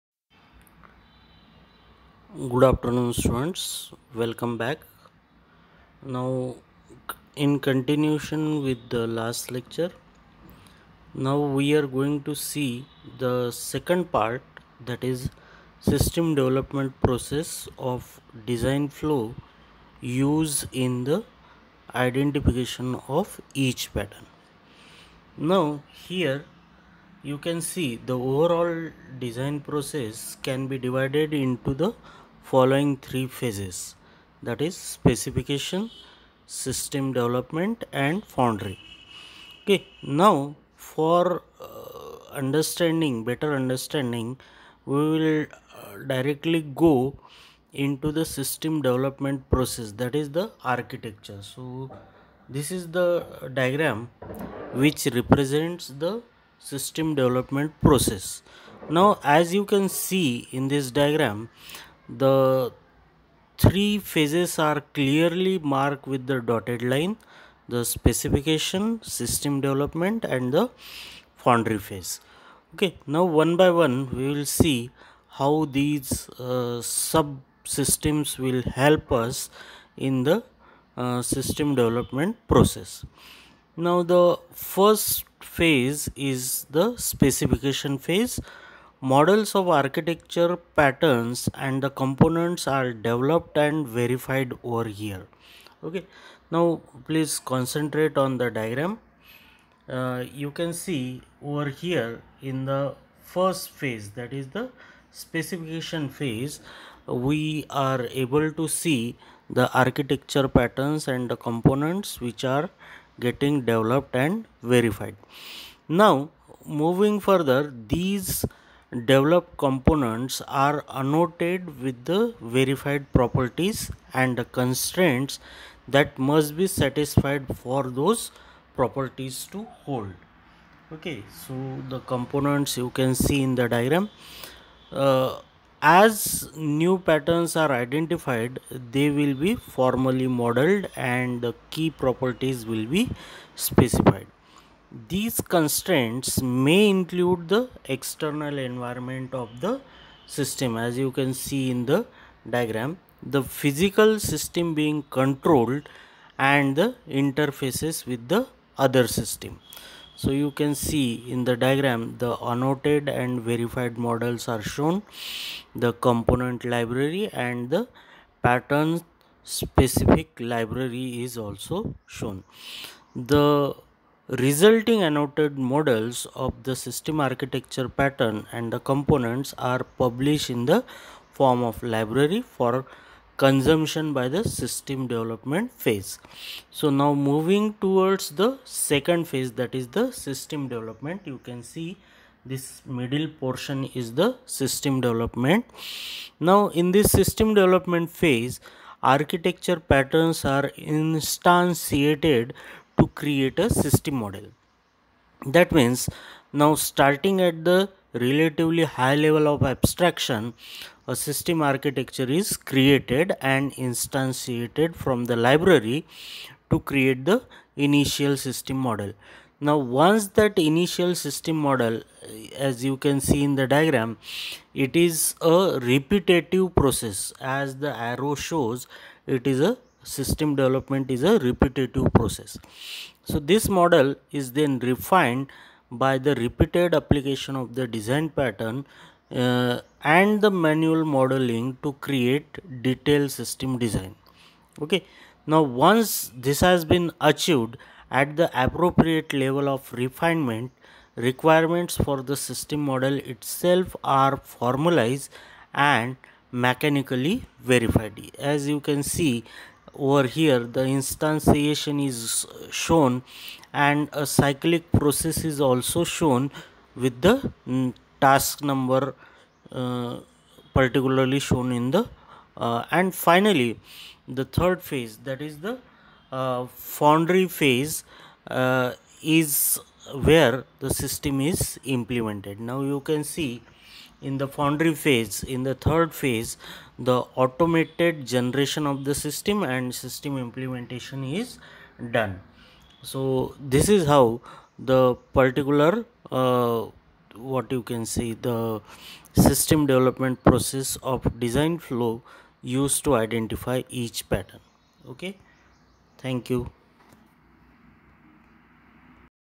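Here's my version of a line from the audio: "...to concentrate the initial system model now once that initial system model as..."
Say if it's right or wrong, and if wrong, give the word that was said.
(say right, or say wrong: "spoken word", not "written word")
wrong: "create", not "concentrate".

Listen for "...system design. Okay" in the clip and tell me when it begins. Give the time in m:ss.
4:03.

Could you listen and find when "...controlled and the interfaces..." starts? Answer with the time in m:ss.
2:35.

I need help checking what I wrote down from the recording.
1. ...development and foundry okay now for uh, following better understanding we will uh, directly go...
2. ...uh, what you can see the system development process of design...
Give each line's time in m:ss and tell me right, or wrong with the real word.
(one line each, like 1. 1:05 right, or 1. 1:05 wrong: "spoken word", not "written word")
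1. 0:37 wrong: "understanding", not "following"
2. 4:56 right.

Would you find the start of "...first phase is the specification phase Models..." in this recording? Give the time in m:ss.
1:24.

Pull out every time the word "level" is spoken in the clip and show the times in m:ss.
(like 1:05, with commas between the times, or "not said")
3:29, 4:09.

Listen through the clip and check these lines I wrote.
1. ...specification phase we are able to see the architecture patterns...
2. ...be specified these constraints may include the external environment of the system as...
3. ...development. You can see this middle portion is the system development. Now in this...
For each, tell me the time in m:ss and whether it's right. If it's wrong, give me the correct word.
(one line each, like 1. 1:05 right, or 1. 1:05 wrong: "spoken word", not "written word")
1. 1:45 right
2. 2:22 right
3. 3:10 right.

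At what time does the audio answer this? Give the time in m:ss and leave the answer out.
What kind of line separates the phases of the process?
1:06.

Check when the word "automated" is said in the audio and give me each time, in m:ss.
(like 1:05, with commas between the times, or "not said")
4:47.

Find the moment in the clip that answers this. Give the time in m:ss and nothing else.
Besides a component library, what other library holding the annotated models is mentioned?
2:48.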